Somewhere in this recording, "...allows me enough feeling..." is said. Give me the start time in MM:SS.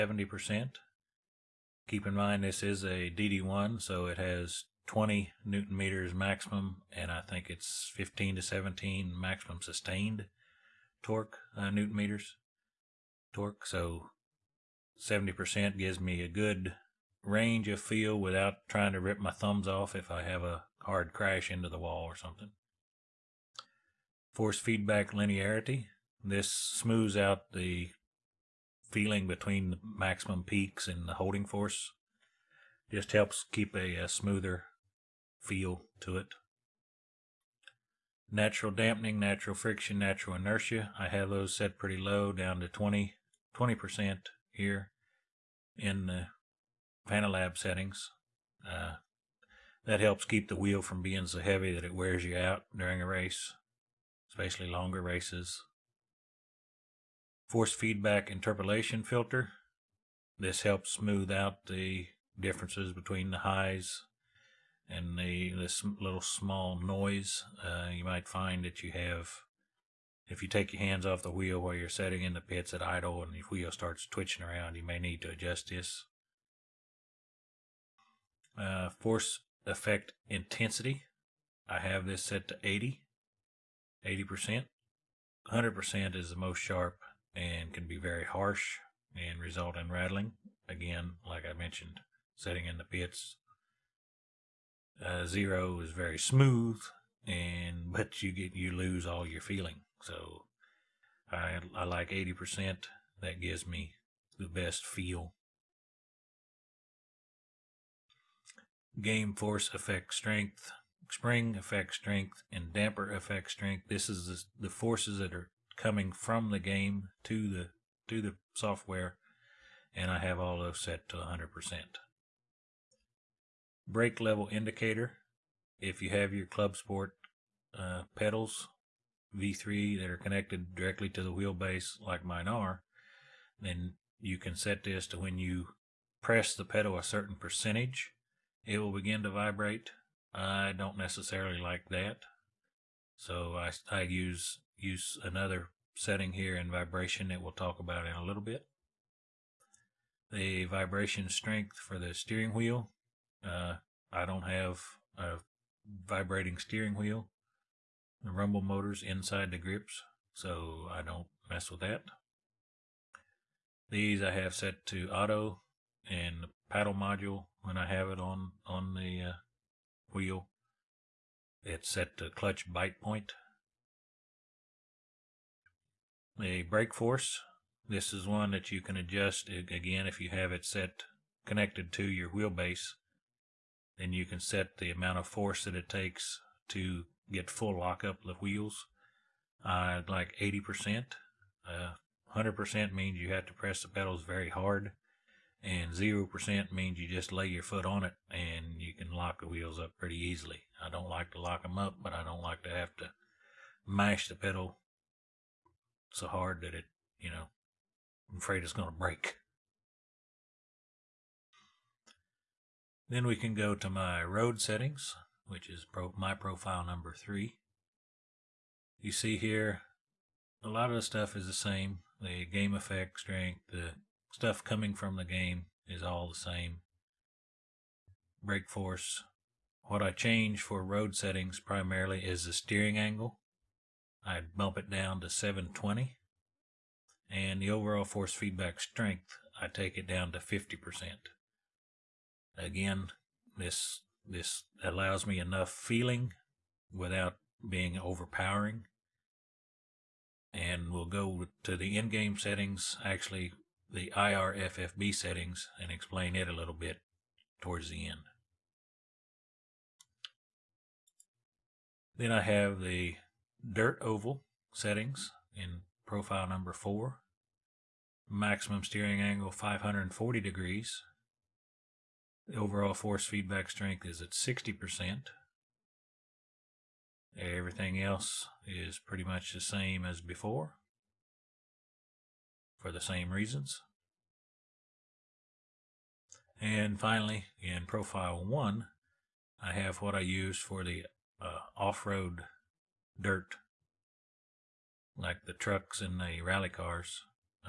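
04:04.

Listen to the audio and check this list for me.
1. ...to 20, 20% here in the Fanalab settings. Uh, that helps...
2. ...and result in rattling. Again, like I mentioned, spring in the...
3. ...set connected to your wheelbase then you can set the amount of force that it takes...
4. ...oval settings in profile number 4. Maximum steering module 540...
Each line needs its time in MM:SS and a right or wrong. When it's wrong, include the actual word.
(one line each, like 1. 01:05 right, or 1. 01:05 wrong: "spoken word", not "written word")
1. 00:42 right
2. 01:29 wrong: "setting", not "spring"
3. 03:00 right
4. 04:24 wrong: "angle", not "module".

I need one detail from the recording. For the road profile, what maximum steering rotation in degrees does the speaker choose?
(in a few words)
720.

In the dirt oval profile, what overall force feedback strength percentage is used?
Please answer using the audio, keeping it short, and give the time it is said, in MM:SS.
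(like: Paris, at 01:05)
60%, at 04:34.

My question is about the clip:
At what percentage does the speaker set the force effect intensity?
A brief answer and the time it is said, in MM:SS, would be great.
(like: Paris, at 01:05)
80%, at 01:21.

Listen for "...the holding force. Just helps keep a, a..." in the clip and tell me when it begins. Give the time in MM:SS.
00:31.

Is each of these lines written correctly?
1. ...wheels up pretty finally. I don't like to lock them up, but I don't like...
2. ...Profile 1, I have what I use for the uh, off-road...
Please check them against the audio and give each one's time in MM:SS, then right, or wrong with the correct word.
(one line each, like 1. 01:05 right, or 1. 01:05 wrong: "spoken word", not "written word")
1. 03:19 wrong: "easily", not "finally"
2. 04:47 right.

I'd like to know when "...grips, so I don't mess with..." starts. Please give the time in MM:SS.
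02:39.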